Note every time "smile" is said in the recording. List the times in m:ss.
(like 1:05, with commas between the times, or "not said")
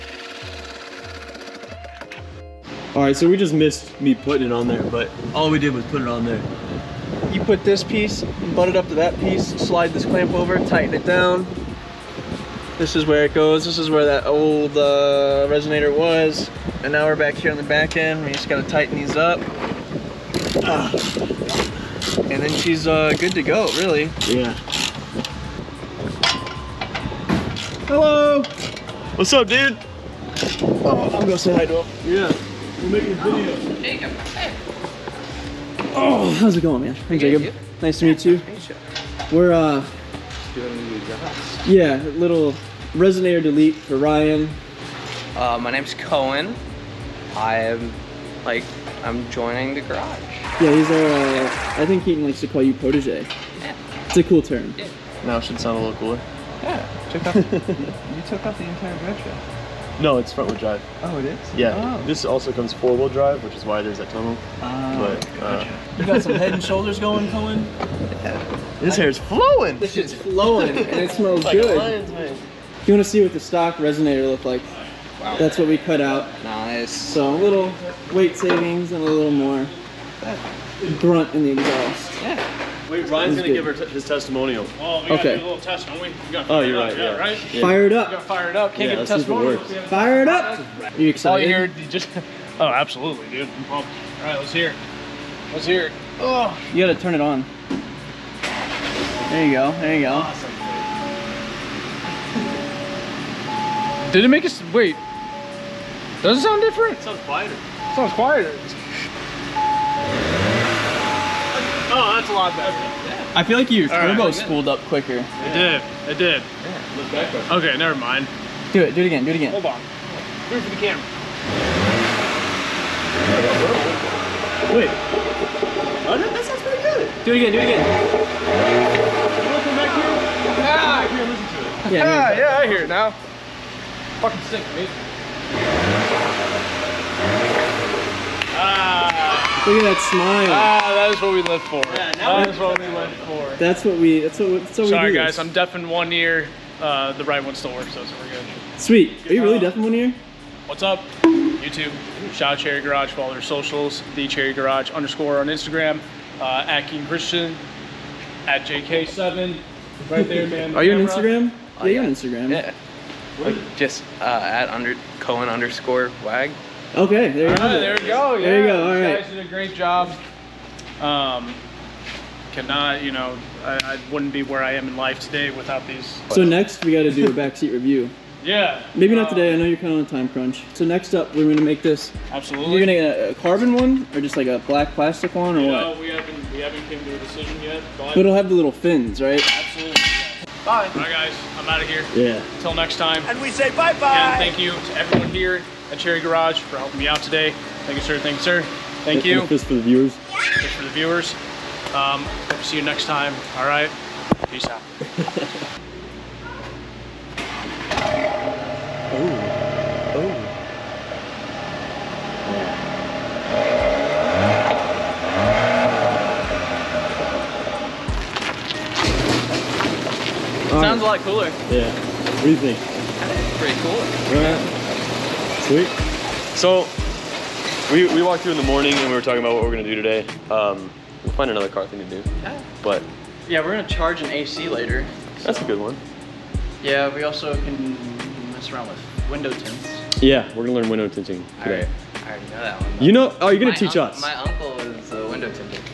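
2:20.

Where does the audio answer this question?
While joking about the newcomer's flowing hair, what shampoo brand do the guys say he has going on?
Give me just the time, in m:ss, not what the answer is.
1:06.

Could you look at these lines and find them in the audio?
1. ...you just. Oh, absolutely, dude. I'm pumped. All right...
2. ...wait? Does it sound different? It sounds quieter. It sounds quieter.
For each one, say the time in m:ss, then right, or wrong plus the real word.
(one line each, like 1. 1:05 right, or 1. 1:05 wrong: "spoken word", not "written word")
1. 1:31 right
2. 1:44 right.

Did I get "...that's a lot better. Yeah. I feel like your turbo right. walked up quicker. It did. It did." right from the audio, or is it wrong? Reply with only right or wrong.
wrong.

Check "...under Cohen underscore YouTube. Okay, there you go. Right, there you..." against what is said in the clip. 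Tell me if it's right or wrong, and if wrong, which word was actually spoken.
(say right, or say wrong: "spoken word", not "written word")
wrong: "Wag", not "YouTube".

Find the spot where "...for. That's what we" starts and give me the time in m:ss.
2:23.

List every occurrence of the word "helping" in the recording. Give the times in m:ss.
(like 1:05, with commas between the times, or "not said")
3:16.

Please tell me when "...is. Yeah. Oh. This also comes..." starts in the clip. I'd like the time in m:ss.
1:01.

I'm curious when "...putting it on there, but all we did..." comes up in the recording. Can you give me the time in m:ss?
0:04.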